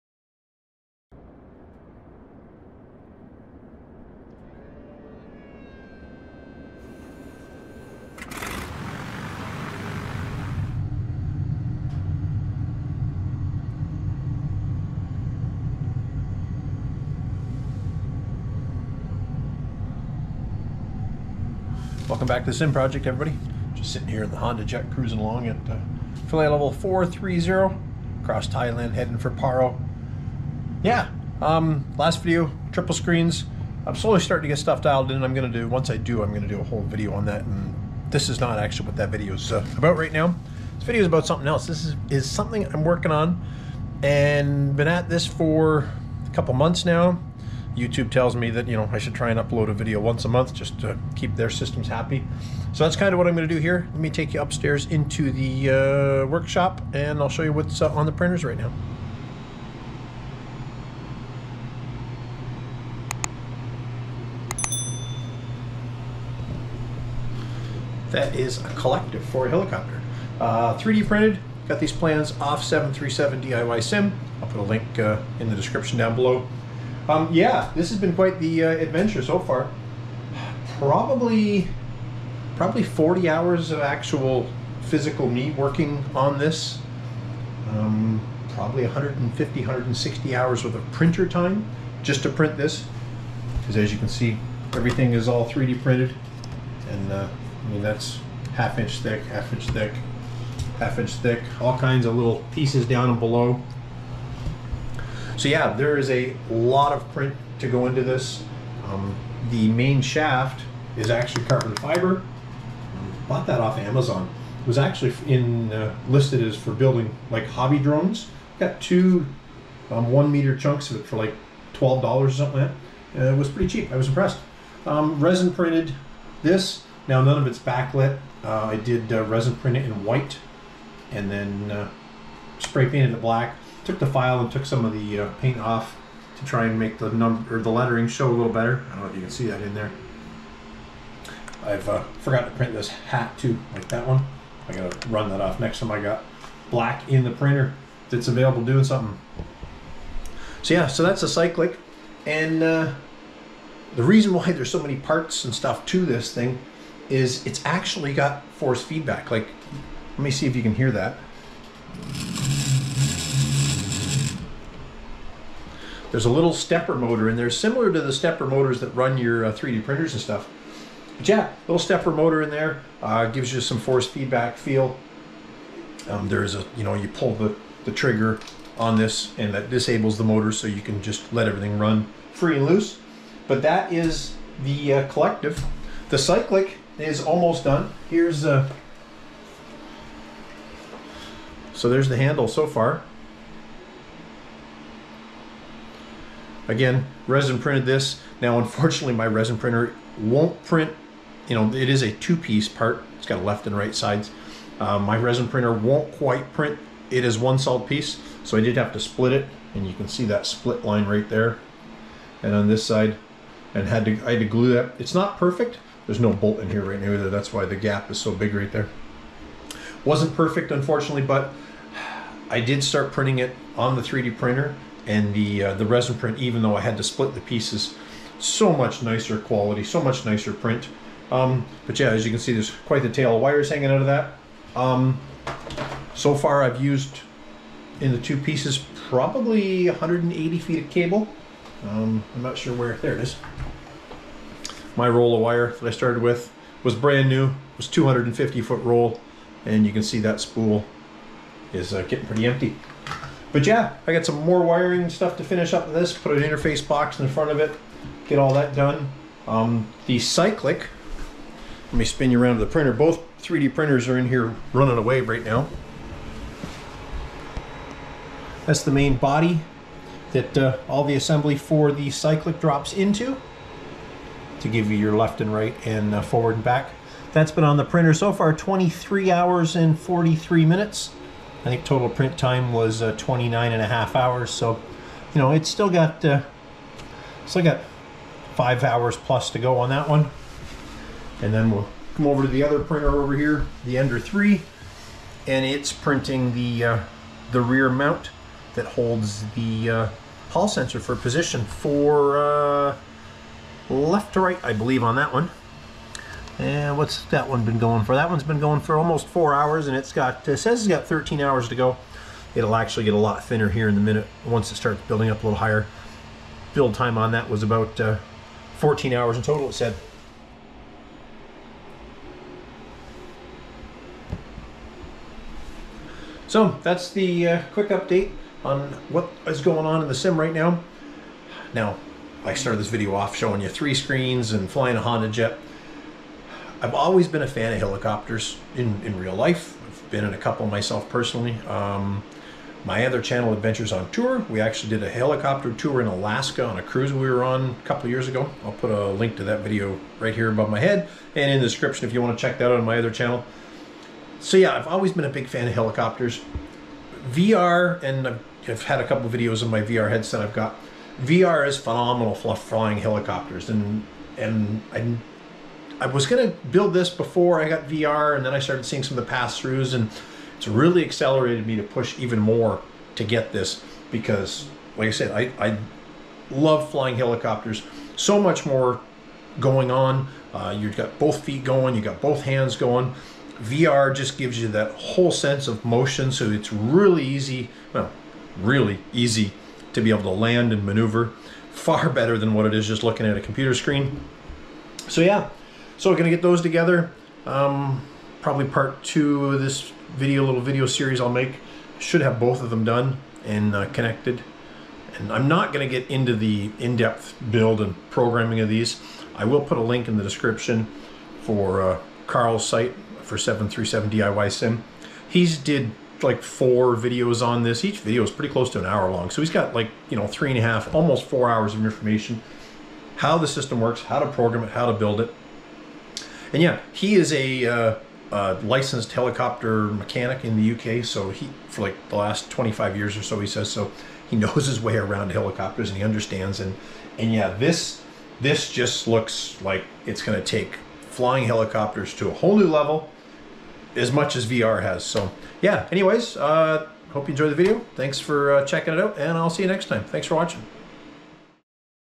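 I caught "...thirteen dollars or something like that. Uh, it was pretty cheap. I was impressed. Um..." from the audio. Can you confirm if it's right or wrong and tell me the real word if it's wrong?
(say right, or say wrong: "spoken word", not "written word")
wrong: "twelve", not "thirteen".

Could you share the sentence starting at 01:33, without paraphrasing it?
Because as you can see, everything is all 3D printed.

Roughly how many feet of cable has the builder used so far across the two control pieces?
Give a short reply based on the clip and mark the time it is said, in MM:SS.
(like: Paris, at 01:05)
180 feet, at 03:59.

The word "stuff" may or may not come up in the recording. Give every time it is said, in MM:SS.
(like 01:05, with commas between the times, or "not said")
00:34, 02:35, 02:50, 04:15.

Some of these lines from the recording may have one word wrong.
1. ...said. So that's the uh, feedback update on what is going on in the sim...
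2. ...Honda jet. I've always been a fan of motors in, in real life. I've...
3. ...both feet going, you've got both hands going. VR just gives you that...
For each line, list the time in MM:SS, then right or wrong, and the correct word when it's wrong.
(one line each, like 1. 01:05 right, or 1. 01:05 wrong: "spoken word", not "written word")
1. 05:19 wrong: "quick", not "feedback"
2. 05:35 wrong: "helicopters", not "motors"
3. 06:21 right.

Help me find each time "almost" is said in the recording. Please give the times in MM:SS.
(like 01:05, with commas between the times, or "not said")
03:07, 05:08, 07:00.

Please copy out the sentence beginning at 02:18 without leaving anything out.
I don't know if you can see that in there.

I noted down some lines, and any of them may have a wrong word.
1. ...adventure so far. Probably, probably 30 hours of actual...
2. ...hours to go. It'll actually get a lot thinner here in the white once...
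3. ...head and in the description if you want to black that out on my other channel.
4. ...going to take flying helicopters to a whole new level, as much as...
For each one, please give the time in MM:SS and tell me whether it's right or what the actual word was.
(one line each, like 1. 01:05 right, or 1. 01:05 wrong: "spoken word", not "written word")
1. 01:18 wrong: "40", not "30"
2. 05:11 wrong: "minute", not "white"
3. 05:50 wrong: "check", not "black"
4. 07:20 right.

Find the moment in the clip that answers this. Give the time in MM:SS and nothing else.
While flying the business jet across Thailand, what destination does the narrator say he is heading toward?
00:29.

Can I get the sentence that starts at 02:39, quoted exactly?
Like, let me see if you can hear that.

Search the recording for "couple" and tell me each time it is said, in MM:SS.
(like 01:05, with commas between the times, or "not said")
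00:46, 05:40, 05:47, 05:59.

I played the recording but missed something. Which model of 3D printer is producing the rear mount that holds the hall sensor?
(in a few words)
Ender 3.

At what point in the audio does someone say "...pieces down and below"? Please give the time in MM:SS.
01:42.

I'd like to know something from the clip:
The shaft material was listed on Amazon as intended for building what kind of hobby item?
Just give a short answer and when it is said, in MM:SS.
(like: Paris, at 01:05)
drones, at 01:57.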